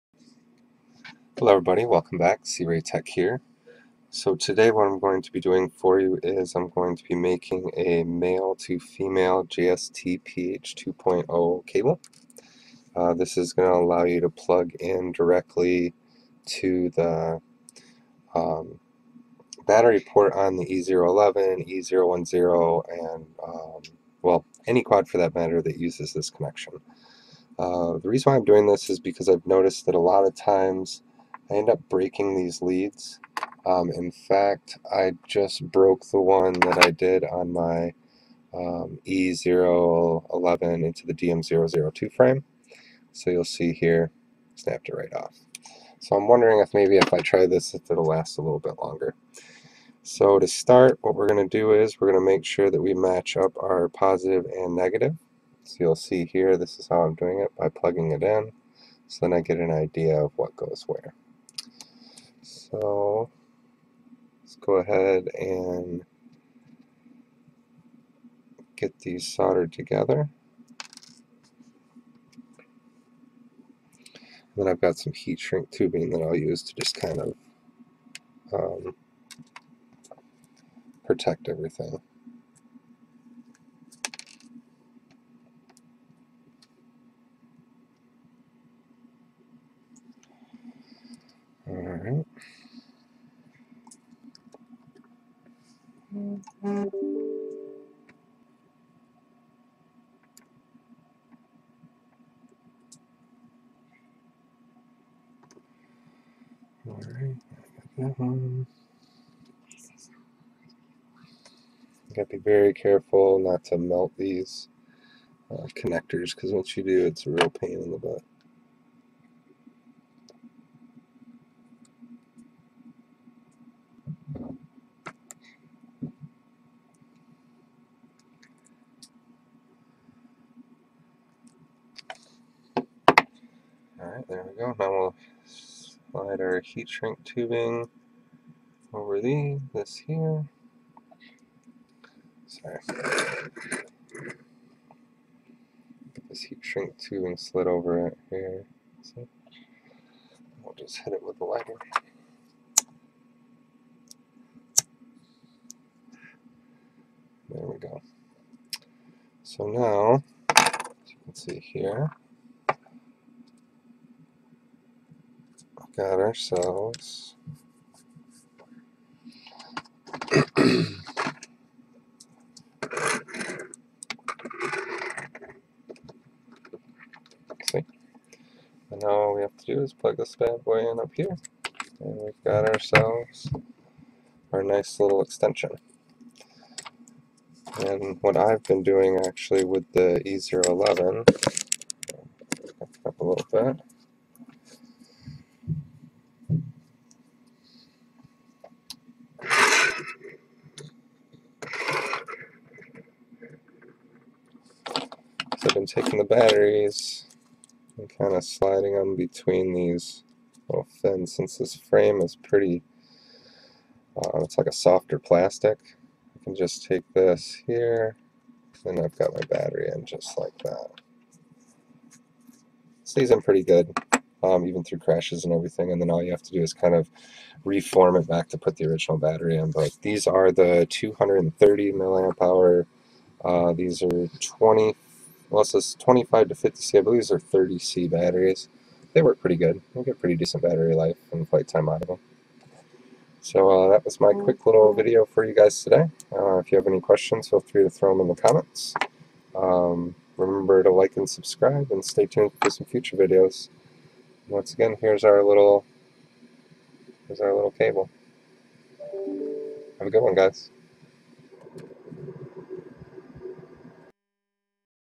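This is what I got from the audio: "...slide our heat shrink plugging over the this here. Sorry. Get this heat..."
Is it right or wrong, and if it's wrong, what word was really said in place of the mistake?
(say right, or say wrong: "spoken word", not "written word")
wrong: "tubing", not "plugging".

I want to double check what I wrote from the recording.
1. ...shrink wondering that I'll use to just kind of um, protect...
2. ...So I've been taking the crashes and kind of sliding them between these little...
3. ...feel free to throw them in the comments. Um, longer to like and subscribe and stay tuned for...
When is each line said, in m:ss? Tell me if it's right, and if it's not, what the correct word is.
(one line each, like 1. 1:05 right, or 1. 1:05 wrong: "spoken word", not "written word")
1. 1:15 wrong: "tubing", not "wondering"
2. 3:20 wrong: "batteries", not "crashes"
3. 4:07 wrong: "remember", not "longer".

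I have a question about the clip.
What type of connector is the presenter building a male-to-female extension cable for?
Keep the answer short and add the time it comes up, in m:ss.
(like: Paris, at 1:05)
JST PH 2.0, at 0:09.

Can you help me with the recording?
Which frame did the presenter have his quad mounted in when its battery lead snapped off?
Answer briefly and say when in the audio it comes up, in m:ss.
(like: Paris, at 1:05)
DM002, at 0:41.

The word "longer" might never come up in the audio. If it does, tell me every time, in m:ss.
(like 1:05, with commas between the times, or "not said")
0:48.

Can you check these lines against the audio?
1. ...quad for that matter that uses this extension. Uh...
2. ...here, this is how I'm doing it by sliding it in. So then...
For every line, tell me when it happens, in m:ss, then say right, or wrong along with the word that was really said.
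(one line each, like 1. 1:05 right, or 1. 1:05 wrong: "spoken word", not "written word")
1. 0:24 wrong: "connection", not "extension"
2. 0:56 wrong: "plugging", not "sliding".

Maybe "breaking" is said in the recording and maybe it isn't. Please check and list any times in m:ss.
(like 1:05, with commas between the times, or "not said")
0:31.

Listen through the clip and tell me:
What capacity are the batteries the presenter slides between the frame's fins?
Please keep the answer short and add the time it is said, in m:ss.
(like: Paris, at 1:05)
230 mAh, at 3:50.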